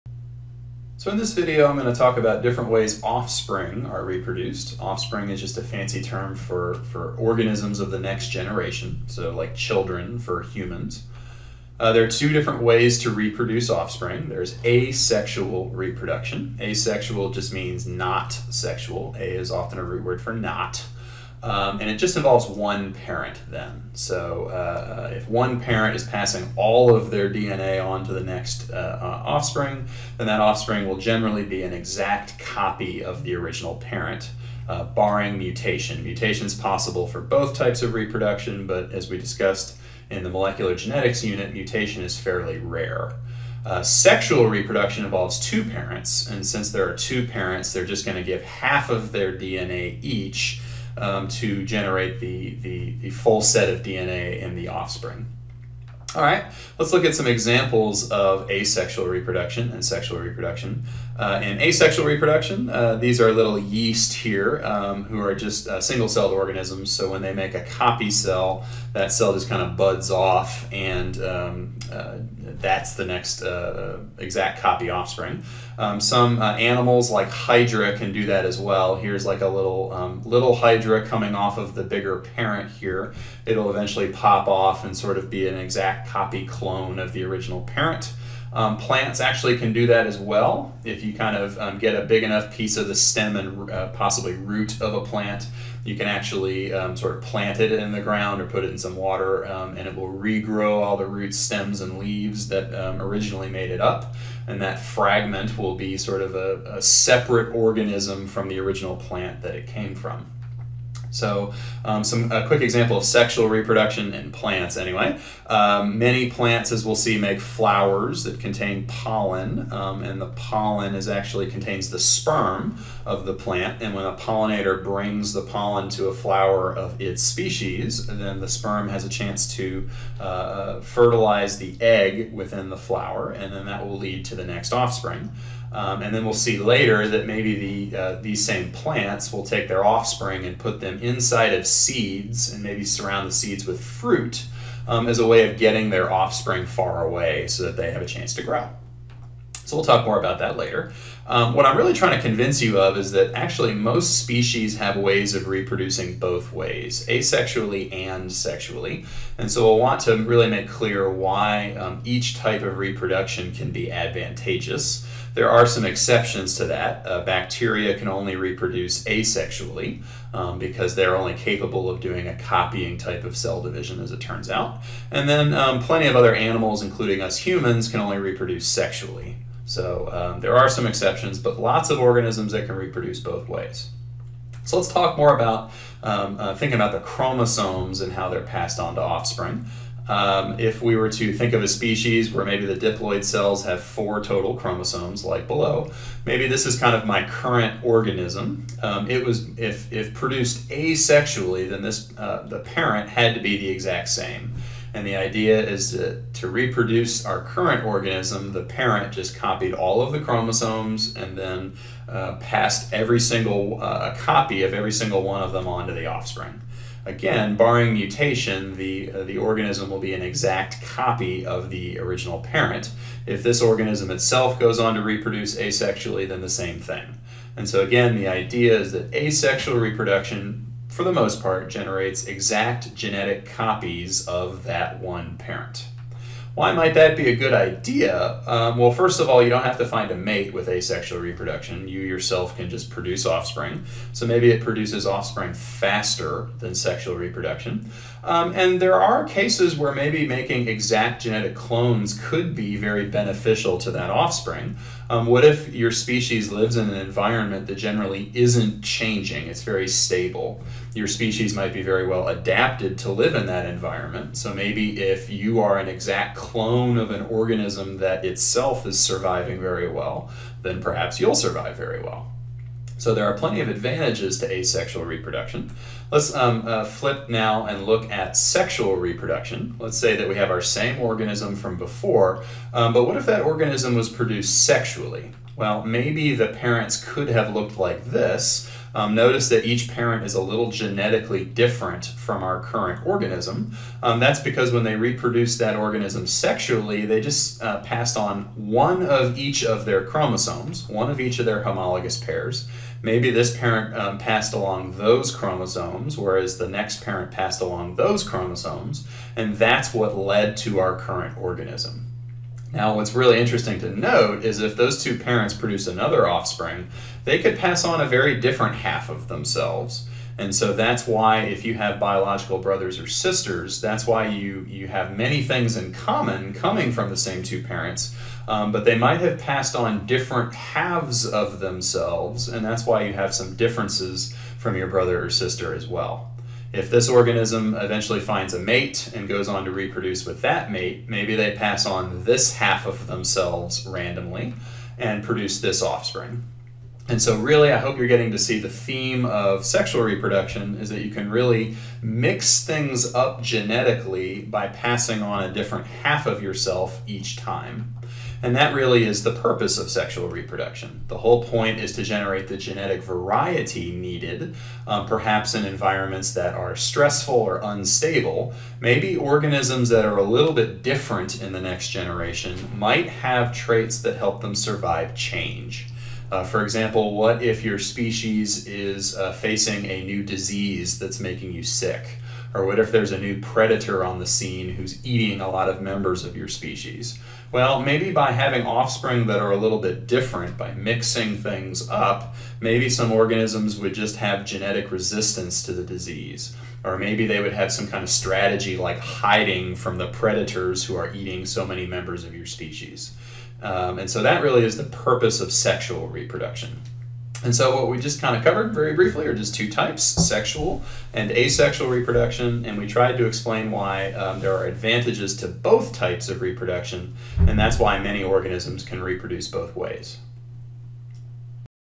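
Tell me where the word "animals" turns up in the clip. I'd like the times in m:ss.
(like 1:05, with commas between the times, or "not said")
1:16, 2:56.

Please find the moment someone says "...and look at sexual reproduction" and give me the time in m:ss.
4:37.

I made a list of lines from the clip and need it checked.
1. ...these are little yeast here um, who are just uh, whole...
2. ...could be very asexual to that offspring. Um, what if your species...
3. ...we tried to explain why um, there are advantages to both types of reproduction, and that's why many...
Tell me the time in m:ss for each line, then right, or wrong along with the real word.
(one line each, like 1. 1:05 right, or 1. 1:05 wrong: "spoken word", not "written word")
1. 1:02 wrong: "single", not "whole"
2. 4:12 wrong: "beneficial", not "asexual"
3. 6:52 right.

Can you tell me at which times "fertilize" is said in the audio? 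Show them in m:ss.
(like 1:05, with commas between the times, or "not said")
2:10.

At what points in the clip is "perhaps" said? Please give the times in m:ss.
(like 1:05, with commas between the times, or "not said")
4:30, 6:05.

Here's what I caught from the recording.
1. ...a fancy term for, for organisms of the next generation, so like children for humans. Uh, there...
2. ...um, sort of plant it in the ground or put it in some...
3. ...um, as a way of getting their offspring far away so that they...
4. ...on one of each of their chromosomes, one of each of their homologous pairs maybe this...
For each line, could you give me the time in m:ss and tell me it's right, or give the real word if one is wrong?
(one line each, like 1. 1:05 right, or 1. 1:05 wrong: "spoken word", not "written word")
1. 0:05 right
2. 1:36 right
3. 2:24 right
4. 4:58 right.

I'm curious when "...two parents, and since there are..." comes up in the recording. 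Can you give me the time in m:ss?
0:45.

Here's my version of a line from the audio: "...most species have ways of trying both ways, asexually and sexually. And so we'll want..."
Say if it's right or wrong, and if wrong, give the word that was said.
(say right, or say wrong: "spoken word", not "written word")
wrong: "reproducing", not "trying".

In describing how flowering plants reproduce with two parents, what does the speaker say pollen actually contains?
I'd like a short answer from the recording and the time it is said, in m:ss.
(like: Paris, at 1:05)
the sperm of the plant, at 2:01.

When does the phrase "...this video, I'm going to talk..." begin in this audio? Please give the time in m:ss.
0:01.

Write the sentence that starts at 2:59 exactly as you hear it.
So um, there are some exceptions, but lots of organisms that can reproduce both ways.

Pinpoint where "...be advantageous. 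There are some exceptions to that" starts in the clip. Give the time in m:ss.
2:43.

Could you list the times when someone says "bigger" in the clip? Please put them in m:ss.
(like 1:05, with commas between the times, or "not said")
1:21.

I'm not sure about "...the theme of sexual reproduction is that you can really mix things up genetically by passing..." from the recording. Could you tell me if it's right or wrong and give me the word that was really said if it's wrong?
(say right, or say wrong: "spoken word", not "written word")
right.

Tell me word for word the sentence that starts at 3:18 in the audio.
Um, it was if if produced asexually, then this uh, the parent had to be the exact same.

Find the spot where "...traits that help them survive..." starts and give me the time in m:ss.
6:13.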